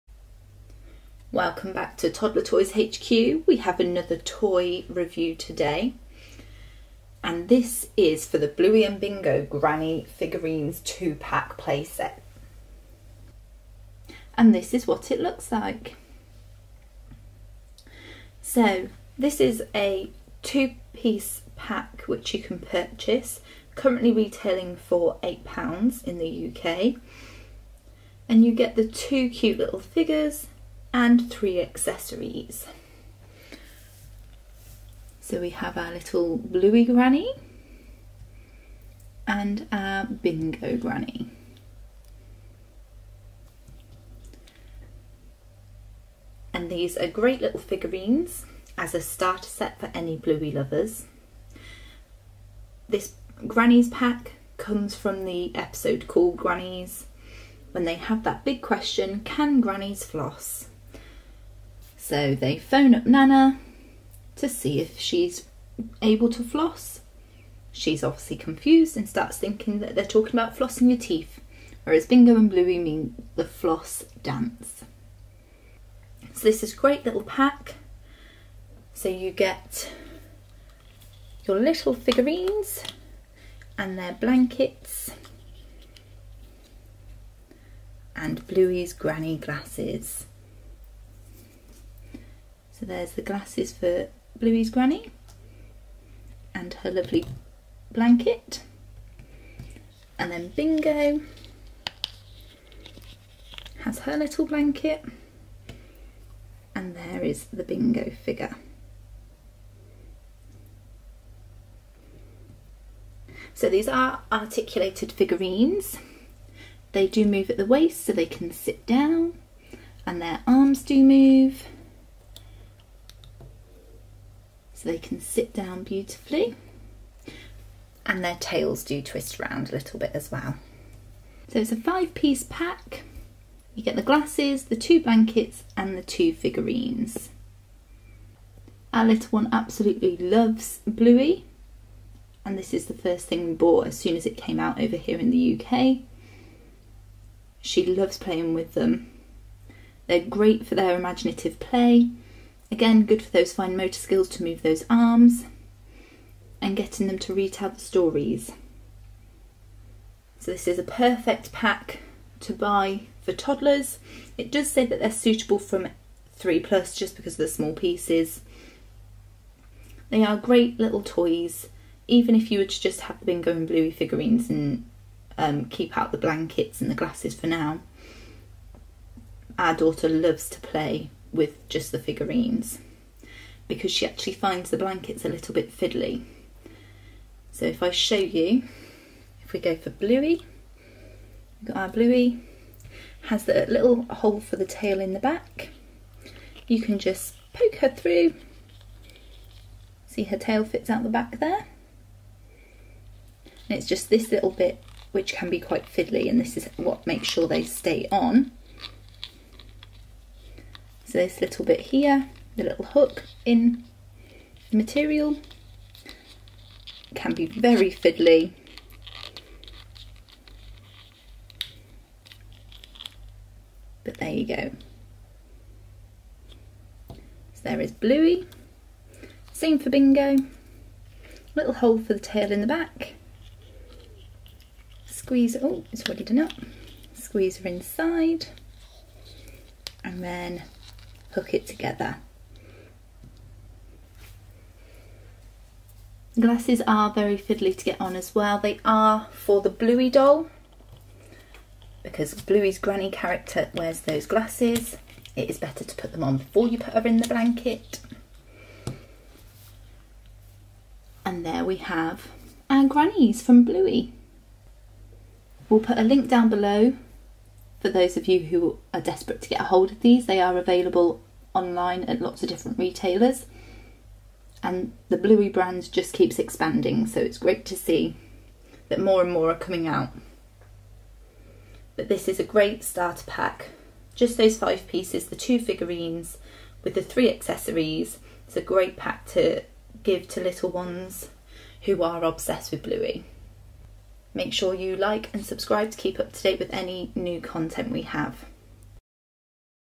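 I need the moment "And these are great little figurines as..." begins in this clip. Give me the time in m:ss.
0:46.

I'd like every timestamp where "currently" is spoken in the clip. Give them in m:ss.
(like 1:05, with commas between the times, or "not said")
0:23.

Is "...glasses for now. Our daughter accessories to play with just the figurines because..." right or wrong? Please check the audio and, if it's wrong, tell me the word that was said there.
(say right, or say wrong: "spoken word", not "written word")
wrong: "loves", not "accessories".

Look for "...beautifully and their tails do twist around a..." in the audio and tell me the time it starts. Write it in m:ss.
2:05.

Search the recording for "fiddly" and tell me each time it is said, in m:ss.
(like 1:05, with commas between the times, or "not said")
3:05, 3:25, 3:37, 4:07.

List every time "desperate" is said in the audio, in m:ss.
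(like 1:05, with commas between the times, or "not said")
4:29.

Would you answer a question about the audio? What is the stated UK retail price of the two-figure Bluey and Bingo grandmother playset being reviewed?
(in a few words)
£8.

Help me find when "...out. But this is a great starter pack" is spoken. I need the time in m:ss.
4:39.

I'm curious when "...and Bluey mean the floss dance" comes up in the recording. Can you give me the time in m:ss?
1:12.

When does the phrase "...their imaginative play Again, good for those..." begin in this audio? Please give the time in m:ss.
2:30.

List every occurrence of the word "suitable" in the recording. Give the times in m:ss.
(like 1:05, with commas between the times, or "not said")
2:45.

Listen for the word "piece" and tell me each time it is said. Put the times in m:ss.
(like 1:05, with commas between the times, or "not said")
0:20, 2:12, 2:47, 4:44.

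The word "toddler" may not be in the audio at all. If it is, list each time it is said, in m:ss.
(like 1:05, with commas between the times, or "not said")
0:02, 2:43.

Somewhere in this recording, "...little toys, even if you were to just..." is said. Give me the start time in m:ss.
2:50.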